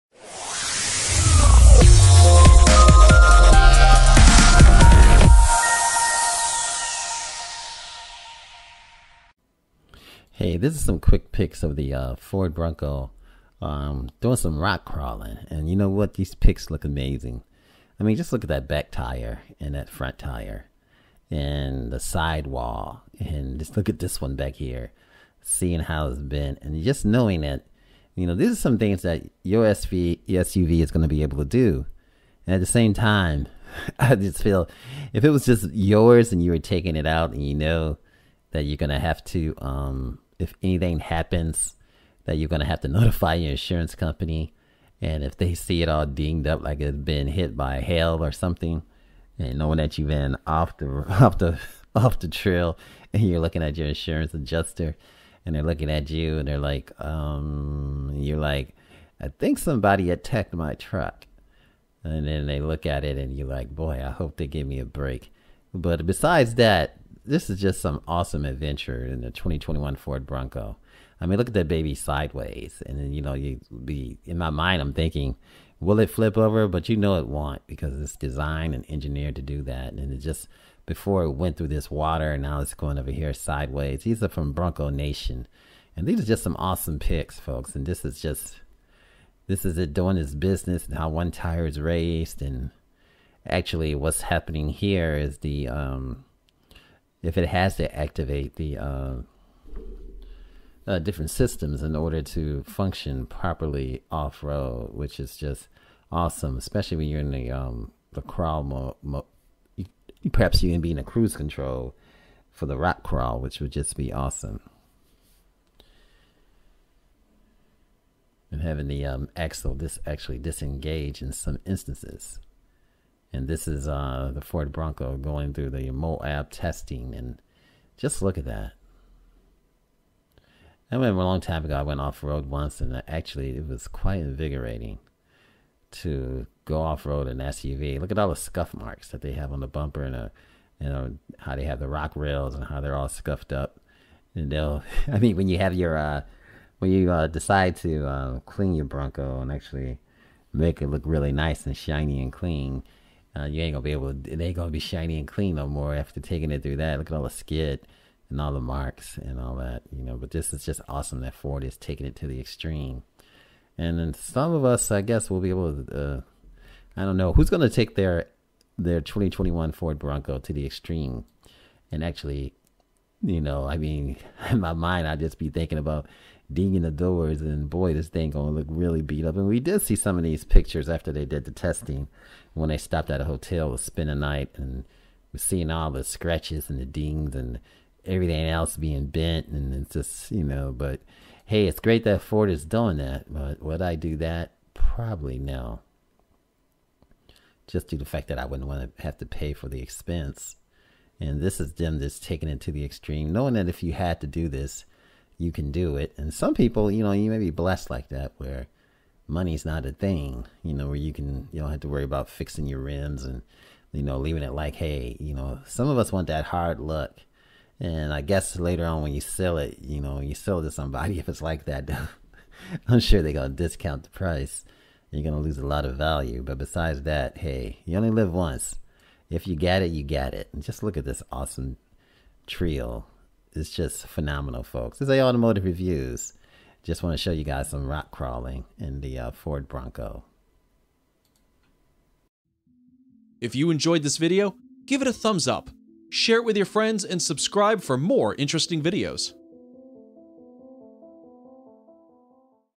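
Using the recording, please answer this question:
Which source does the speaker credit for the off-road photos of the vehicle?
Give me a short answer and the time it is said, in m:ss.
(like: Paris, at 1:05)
Bronco Nation, at 1:24.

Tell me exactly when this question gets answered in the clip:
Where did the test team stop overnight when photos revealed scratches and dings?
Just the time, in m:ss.
3:03.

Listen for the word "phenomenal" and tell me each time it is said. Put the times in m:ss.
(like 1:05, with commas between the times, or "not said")
3:54.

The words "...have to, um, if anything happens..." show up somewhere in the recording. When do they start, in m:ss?
0:38.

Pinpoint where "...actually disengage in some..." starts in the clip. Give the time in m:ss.
2:00.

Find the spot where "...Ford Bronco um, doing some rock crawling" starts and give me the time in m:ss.
0:12.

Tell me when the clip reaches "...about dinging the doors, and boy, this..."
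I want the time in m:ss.
2:55.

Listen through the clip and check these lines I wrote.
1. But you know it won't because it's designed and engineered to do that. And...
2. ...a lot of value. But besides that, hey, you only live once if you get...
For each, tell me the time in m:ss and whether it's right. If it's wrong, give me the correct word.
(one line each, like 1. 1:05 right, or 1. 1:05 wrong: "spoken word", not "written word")
1. 1:16 right
2. 3:45 right.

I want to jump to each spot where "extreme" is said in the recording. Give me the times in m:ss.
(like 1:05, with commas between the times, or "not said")
2:42, 2:50, 3:22.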